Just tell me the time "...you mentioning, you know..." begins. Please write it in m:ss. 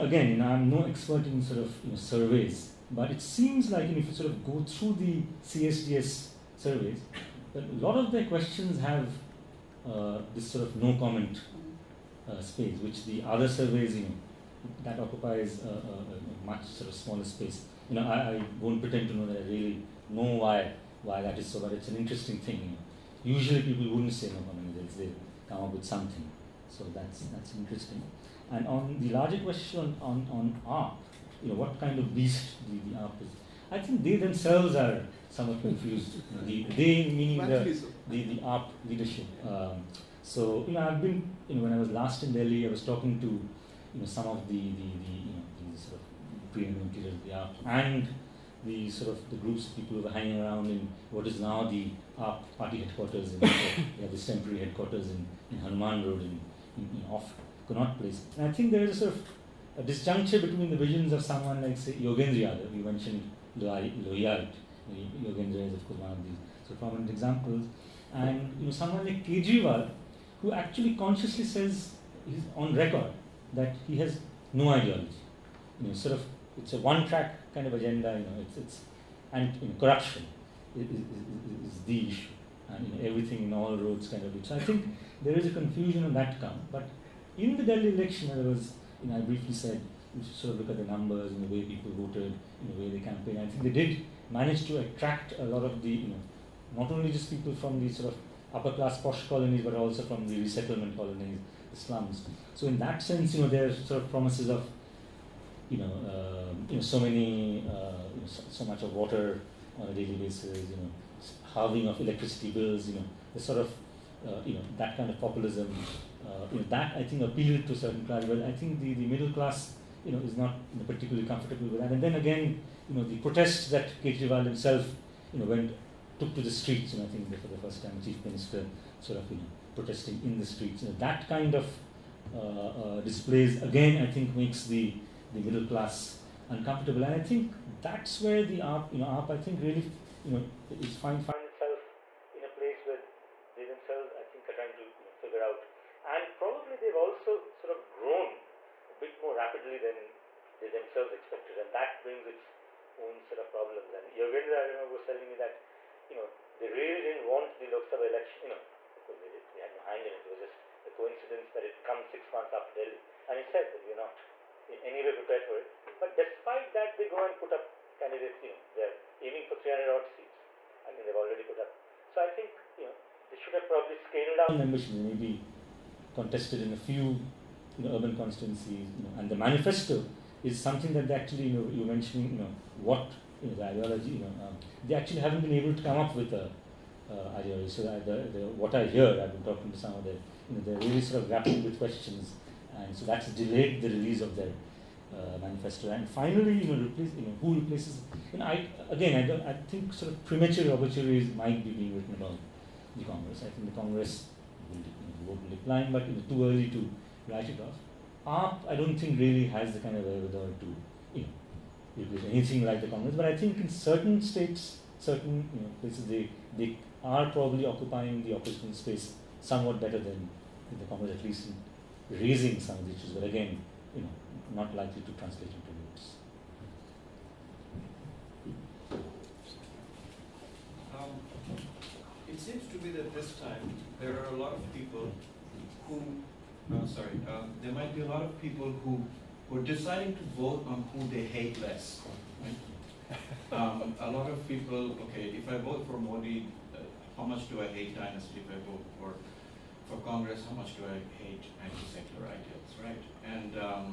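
3:01.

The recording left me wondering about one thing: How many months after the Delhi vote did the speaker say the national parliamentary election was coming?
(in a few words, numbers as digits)
6.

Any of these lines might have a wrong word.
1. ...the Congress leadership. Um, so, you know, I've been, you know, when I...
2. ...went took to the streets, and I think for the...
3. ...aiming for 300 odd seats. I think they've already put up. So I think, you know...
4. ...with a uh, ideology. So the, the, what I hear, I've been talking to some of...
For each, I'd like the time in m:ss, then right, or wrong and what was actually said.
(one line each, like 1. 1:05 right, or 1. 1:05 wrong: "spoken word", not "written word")
1. 0:38 wrong: "AAP", not "Congress"
2. 2:05 right
3. 2:49 right
4. 3:06 right.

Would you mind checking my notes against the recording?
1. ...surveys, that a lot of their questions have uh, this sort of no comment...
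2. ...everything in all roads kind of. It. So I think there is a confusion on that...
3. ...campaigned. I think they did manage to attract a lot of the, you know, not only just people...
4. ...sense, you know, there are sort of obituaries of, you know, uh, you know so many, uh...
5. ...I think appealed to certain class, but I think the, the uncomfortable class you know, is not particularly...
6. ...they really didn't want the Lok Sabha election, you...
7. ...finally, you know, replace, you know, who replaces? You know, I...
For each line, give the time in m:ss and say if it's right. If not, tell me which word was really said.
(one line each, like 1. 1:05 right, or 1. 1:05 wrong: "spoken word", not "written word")
1. 0:06 right
2. 1:23 right
3. 1:32 right
4. 1:43 wrong: "promises", not "obituaries"
5. 1:56 wrong: "middle", not "uncomfortable"
6. 2:36 right
7. 3:16 right.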